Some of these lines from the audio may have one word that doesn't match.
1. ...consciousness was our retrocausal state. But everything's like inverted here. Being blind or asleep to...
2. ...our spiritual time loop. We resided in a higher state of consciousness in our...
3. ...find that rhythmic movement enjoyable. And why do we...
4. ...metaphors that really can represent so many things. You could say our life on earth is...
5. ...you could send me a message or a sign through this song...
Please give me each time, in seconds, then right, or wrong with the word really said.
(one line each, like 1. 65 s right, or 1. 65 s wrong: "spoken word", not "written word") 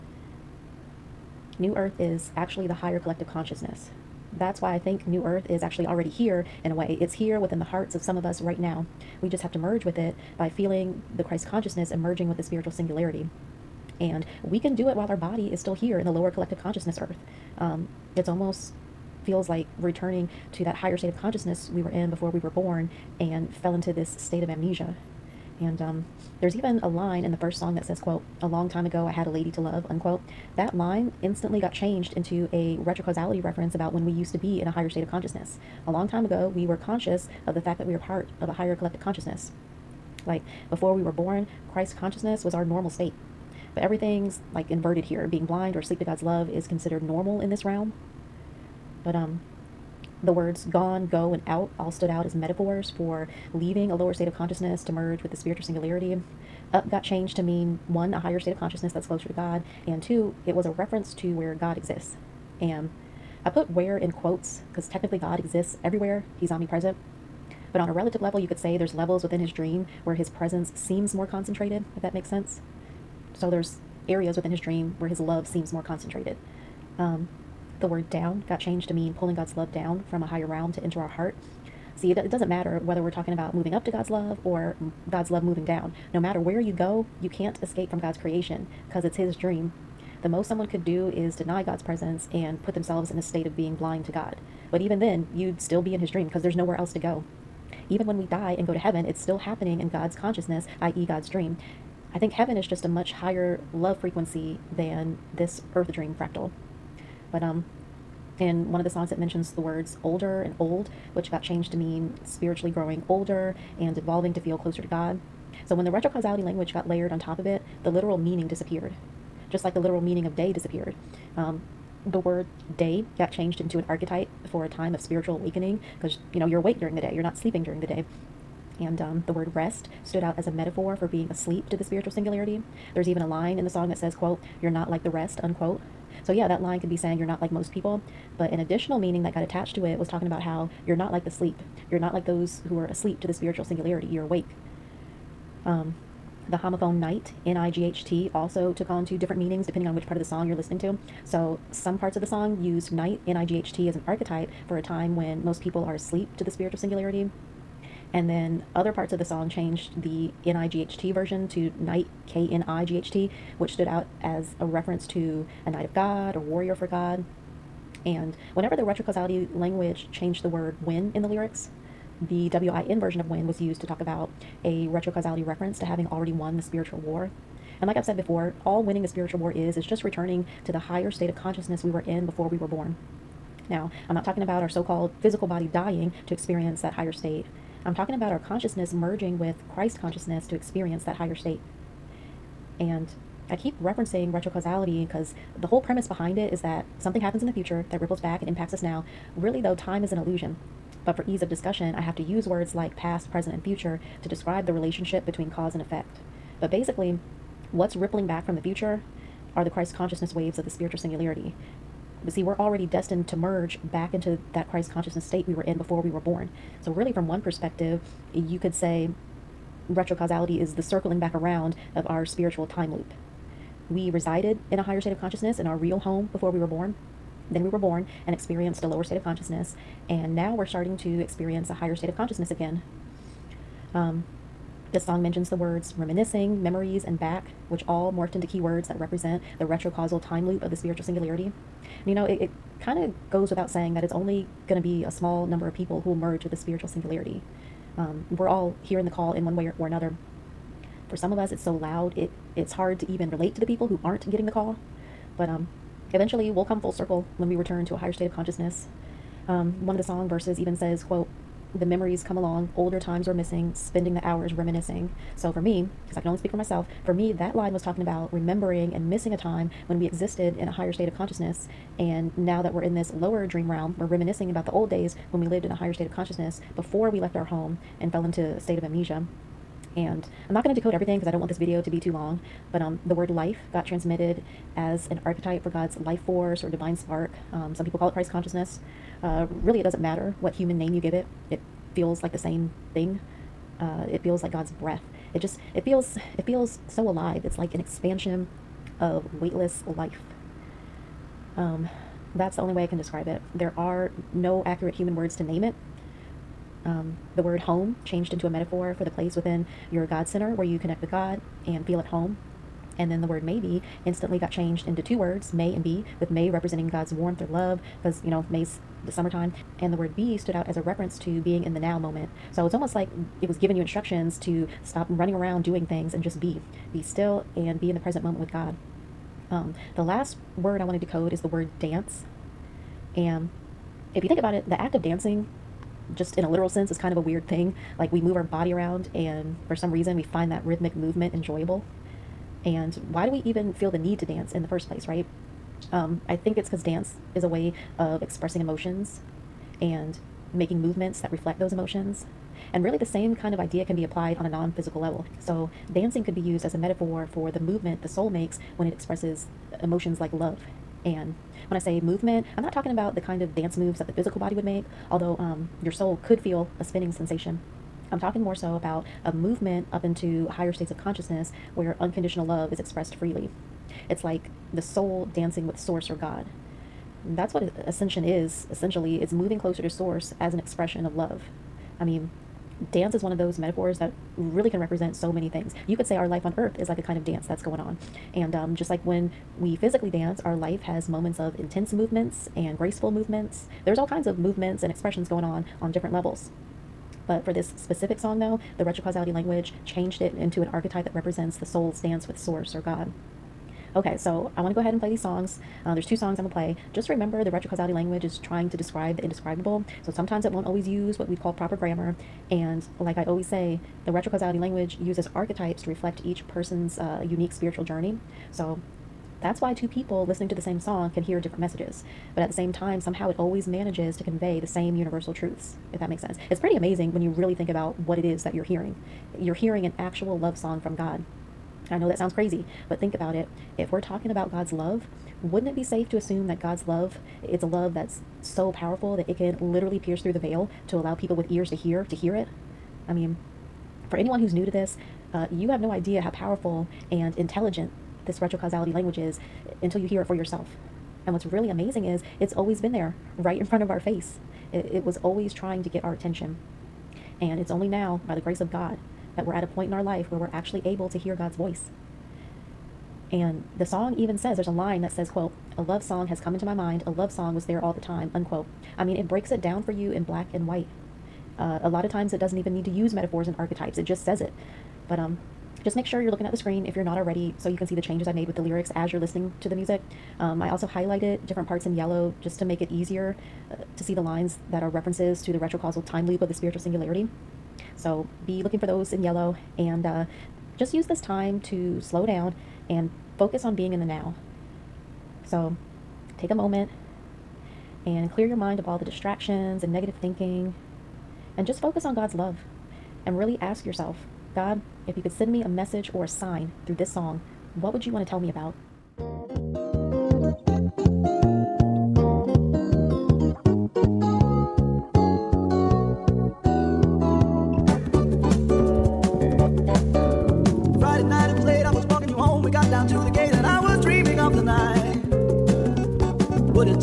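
1. 42 s wrong: "normal", not "retrocausal"
2. 222 s right
3. 340 s right
4. 383 s right
5. 505 s right.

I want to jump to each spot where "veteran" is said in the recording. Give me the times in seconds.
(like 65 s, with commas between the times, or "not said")
not said.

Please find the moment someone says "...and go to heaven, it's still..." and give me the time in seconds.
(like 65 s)
98 s.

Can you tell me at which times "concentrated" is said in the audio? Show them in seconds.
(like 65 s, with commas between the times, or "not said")
71 s, 75 s.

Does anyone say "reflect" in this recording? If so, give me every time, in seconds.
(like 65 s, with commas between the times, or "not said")
351 s, 415 s.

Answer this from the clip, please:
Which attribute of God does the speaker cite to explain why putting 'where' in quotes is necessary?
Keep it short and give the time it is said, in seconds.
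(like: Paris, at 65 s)
Omnipresent, at 66 s.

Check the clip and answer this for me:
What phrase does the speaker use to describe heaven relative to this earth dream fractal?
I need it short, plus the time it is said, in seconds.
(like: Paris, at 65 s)
A much higher love frequency, at 102 s.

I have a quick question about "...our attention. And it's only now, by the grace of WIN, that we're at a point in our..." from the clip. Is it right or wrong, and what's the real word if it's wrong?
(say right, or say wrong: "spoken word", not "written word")
wrong: "God", not "WIN".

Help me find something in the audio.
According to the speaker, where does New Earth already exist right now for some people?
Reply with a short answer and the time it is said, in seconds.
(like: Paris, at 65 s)
Within the hearts, at 7 s.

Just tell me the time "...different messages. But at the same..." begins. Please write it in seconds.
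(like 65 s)
421 s.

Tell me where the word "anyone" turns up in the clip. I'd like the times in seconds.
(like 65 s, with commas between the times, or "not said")
444 s.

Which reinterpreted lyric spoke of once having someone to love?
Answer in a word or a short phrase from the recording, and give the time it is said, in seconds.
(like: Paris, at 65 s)
A long time ago I had a lady to love, at 28 s.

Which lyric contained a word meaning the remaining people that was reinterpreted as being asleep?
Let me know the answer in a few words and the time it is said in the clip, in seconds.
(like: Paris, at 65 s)
You're not like the rest, at 134 s.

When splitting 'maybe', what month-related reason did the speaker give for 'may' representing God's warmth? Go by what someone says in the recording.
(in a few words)
May's the summertime.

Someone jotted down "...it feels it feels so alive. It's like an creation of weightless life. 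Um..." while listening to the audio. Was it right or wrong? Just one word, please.
wrong.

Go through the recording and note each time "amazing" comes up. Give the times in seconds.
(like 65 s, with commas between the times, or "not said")
426 s, 451 s.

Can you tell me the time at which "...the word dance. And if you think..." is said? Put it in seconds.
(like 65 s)
331 s.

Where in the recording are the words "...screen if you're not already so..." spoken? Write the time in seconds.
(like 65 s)
476 s.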